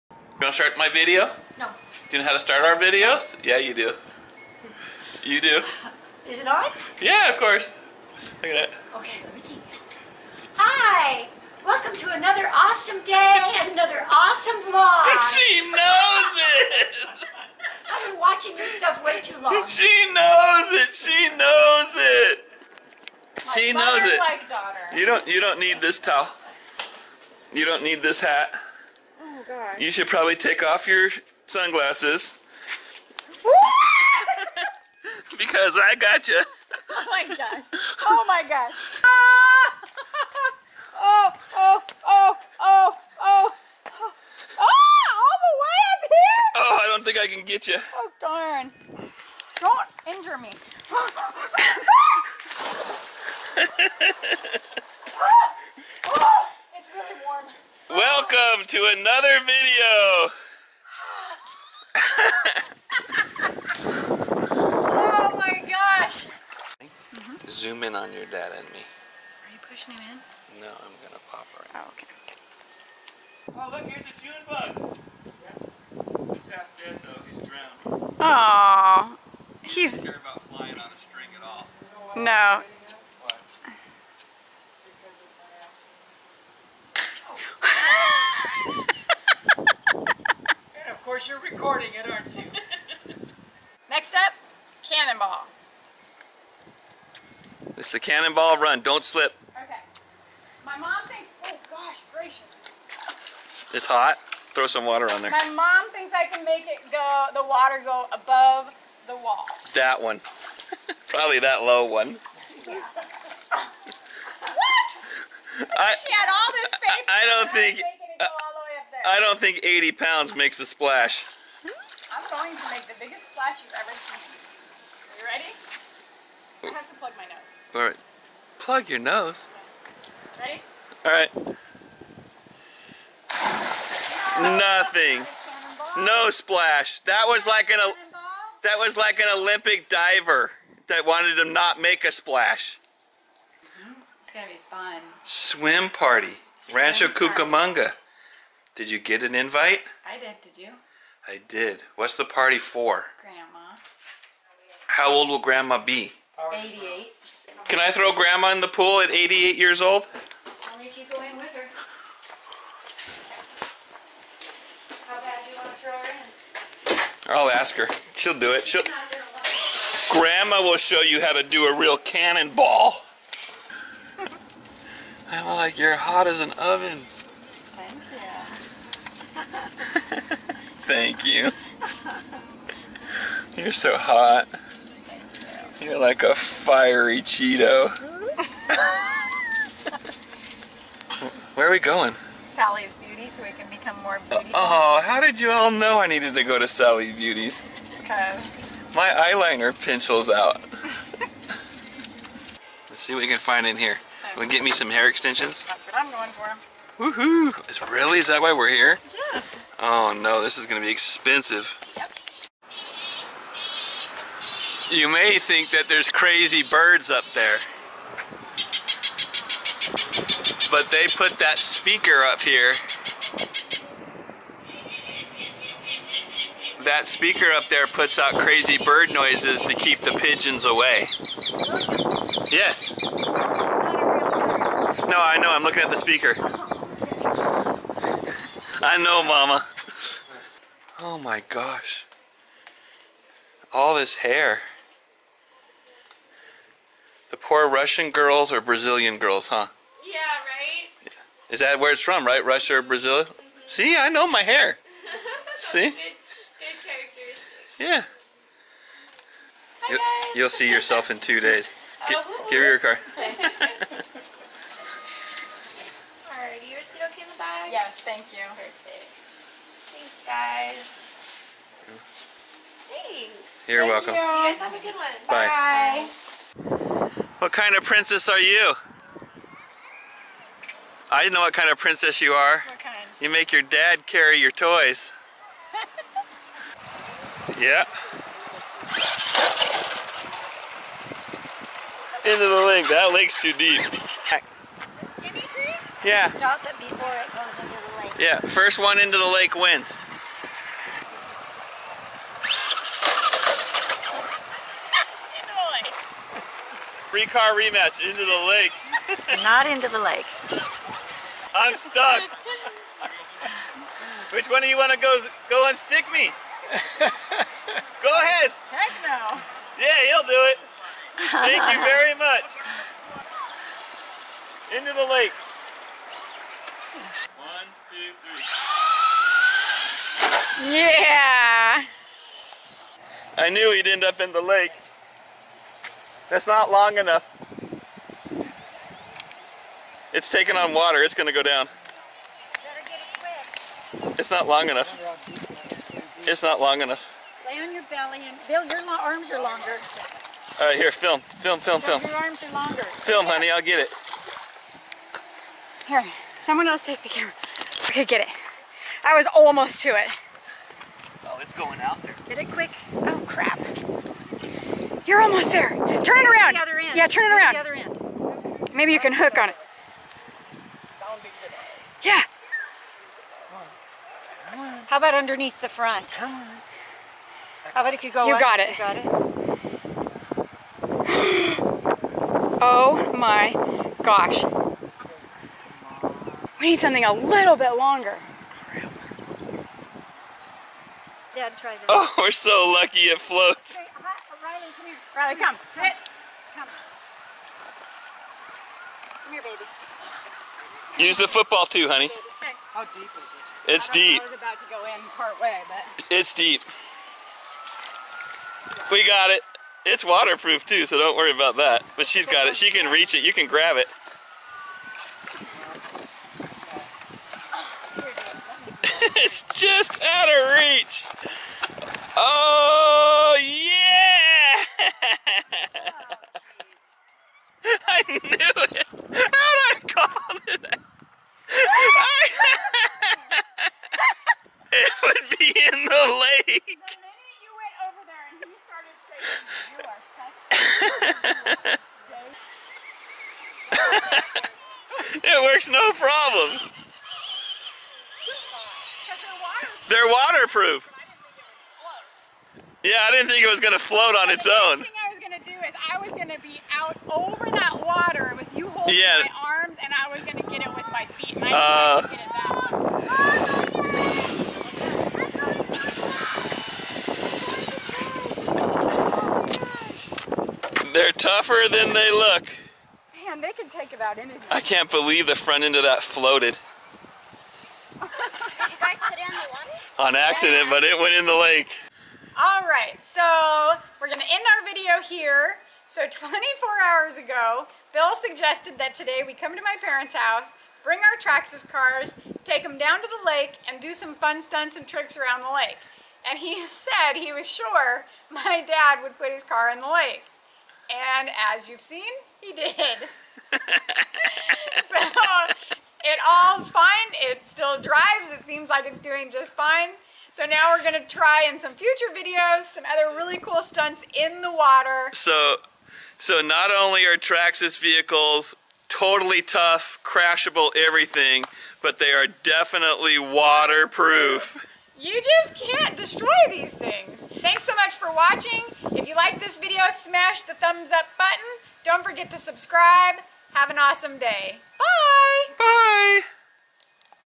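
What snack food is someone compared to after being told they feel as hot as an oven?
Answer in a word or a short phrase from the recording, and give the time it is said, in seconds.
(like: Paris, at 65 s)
Cheeto, at 187 s.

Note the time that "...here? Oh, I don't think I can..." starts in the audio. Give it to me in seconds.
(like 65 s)
46 s.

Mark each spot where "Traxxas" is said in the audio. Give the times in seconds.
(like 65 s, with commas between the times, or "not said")
491 s, 517 s.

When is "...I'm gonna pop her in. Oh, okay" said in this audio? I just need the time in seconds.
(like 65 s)
70 s.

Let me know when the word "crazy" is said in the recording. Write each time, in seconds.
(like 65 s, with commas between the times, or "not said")
216 s, 228 s.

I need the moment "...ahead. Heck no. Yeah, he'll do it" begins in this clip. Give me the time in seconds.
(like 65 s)
318 s.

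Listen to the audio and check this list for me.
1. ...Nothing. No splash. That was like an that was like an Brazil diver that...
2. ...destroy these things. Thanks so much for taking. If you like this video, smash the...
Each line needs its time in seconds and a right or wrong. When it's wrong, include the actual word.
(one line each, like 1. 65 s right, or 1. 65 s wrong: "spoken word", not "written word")
1. 134 s wrong: "Olympic", not "Brazil"
2. 525 s wrong: "watching", not "taking".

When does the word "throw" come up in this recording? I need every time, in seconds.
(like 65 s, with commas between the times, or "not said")
104 s, 157 s, 165 s.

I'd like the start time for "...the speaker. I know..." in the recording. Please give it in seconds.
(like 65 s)
235 s.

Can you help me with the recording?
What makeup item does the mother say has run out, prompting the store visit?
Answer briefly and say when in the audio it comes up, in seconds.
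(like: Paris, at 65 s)
Eyeliner pencil, at 199 s.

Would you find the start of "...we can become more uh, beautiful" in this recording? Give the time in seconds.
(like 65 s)
193 s.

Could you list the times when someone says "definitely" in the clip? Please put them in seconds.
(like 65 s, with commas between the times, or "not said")
522 s.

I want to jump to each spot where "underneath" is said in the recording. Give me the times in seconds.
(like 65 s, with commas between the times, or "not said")
375 s.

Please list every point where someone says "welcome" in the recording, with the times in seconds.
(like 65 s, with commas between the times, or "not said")
11 s, 58 s, 274 s.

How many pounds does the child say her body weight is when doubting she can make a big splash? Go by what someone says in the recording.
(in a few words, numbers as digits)
80.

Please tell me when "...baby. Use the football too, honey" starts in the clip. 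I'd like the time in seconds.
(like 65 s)
399 s.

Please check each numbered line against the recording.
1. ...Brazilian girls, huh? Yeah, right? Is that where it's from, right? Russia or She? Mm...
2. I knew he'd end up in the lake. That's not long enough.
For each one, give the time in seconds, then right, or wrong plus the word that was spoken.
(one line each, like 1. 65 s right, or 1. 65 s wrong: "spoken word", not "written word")
1. 248 s wrong: "Brazil", not "She"
2. 333 s right.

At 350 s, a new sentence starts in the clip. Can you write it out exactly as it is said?
All right, here, film, film, film, film.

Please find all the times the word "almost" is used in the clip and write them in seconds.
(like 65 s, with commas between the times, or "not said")
359 s, 365 s.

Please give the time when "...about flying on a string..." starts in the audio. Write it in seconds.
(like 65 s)
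80 s.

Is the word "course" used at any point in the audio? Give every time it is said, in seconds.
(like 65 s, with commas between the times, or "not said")
7 s, 91 s.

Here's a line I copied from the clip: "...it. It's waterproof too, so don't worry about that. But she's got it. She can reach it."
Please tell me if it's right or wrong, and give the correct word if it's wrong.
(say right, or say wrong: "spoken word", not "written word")
right.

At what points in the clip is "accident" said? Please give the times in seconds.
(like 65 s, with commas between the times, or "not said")
480 s.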